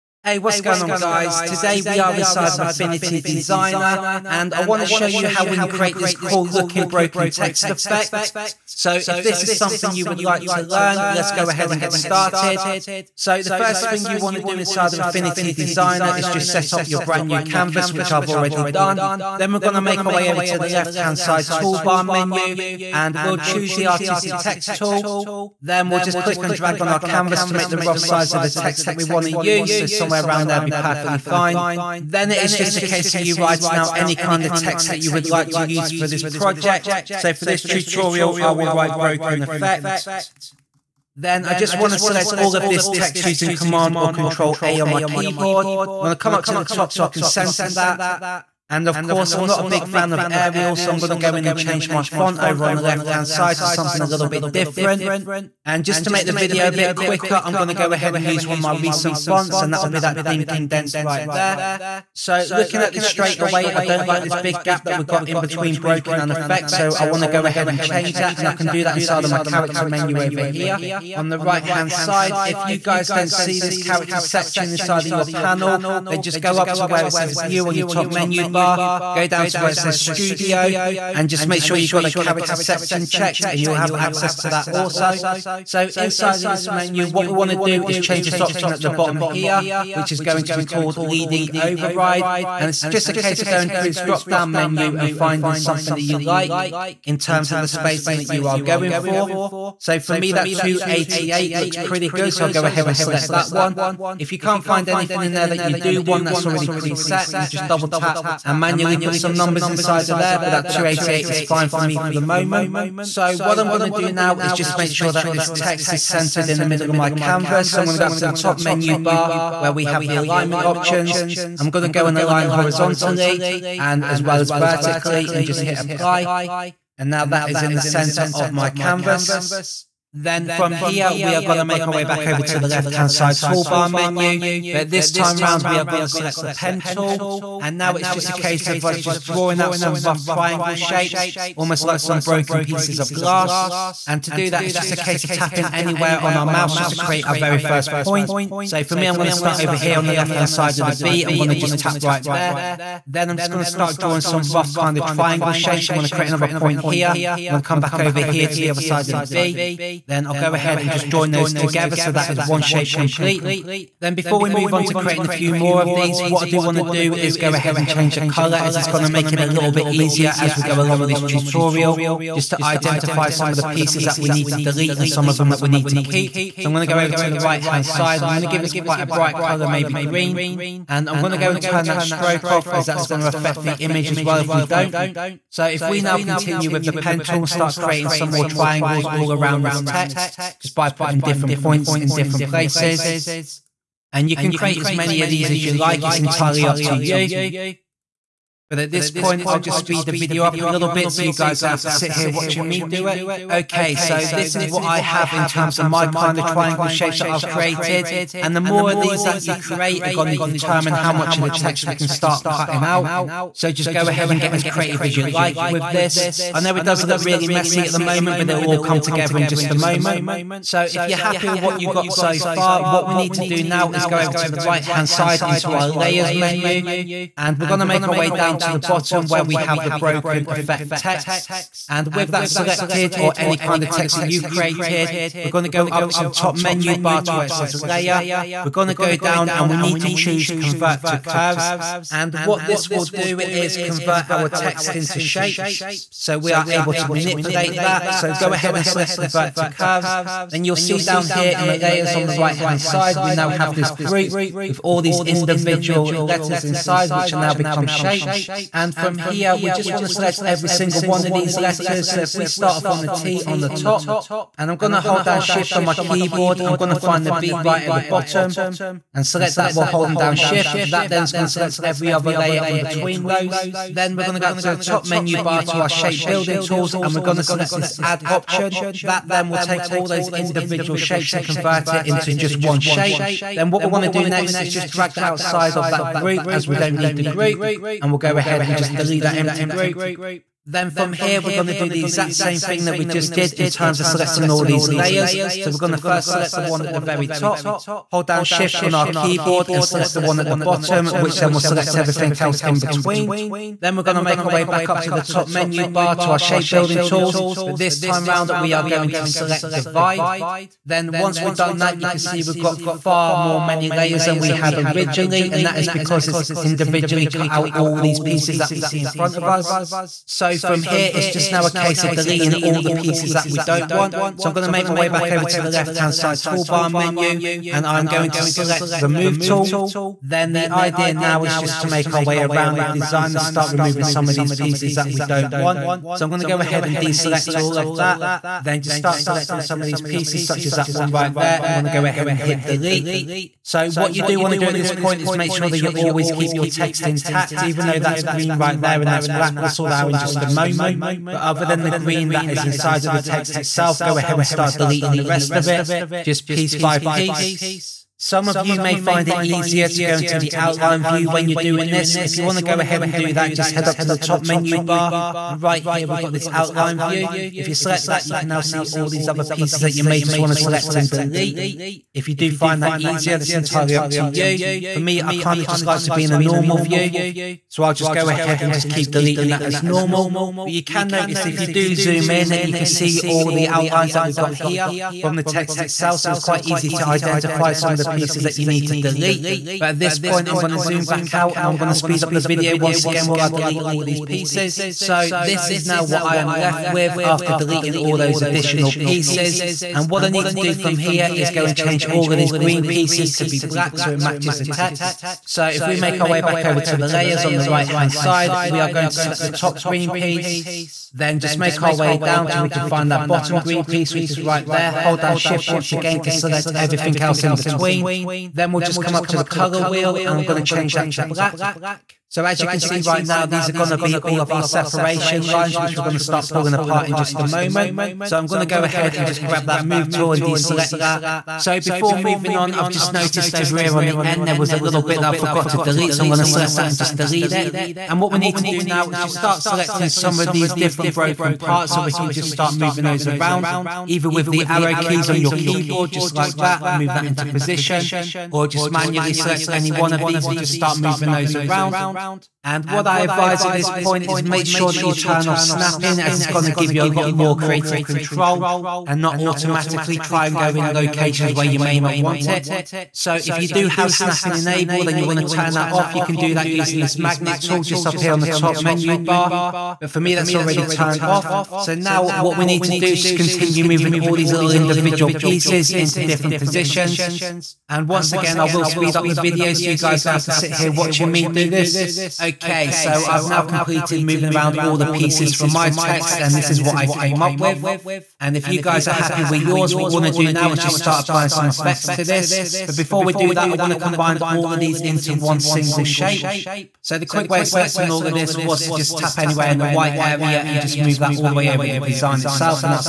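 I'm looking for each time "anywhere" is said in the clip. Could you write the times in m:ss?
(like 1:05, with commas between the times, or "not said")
2:25, 8:19.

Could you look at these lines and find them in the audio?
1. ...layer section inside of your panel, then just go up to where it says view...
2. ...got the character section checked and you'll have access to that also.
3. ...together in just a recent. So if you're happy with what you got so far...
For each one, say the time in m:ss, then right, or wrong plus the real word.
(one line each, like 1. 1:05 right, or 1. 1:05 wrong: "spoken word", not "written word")
1. 1:13 wrong: "character", not "layer"
2. 1:21 right
3. 3:38 wrong: "moment", not "recent".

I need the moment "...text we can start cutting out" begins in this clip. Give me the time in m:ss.
3:31.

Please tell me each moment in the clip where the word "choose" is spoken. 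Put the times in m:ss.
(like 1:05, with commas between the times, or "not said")
0:23, 4:00.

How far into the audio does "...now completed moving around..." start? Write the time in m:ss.
8:03.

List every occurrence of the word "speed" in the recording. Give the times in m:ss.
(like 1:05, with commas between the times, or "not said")
3:19, 6:31, 7:58.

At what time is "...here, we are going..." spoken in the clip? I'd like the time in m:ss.
2:10.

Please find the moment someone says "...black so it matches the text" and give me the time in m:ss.
6:43.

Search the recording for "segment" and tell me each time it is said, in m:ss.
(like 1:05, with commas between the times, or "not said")
not said.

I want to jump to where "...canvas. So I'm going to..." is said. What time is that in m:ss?
1:57.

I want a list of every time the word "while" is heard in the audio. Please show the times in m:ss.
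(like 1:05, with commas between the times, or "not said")
4:29, 6:33.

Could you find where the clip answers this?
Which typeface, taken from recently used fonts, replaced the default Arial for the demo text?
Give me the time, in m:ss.
1:00.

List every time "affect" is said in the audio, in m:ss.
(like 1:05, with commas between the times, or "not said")
3:03.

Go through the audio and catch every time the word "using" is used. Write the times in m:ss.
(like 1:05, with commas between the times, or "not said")
0:43, 7:46.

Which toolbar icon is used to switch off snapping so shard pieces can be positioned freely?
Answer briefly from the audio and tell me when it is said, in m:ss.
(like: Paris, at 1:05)
magnet tool, at 7:47.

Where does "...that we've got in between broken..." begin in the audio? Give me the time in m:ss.
1:04.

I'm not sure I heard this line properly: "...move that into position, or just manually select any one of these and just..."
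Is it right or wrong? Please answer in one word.
right.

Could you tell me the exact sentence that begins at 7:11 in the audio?
So before moving on, I've just noticed over here on the end, there was a little bit that I forgot to delete.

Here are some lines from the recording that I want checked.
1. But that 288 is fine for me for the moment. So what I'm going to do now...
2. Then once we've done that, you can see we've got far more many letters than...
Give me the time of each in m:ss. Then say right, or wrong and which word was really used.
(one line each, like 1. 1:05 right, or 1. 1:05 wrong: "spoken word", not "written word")
1. 1:50 right
2. 5:10 wrong: "layers", not "letters".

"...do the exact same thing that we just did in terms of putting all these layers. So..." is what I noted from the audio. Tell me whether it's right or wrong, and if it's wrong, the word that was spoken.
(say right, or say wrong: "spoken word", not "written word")
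wrong: "selecting", not "putting".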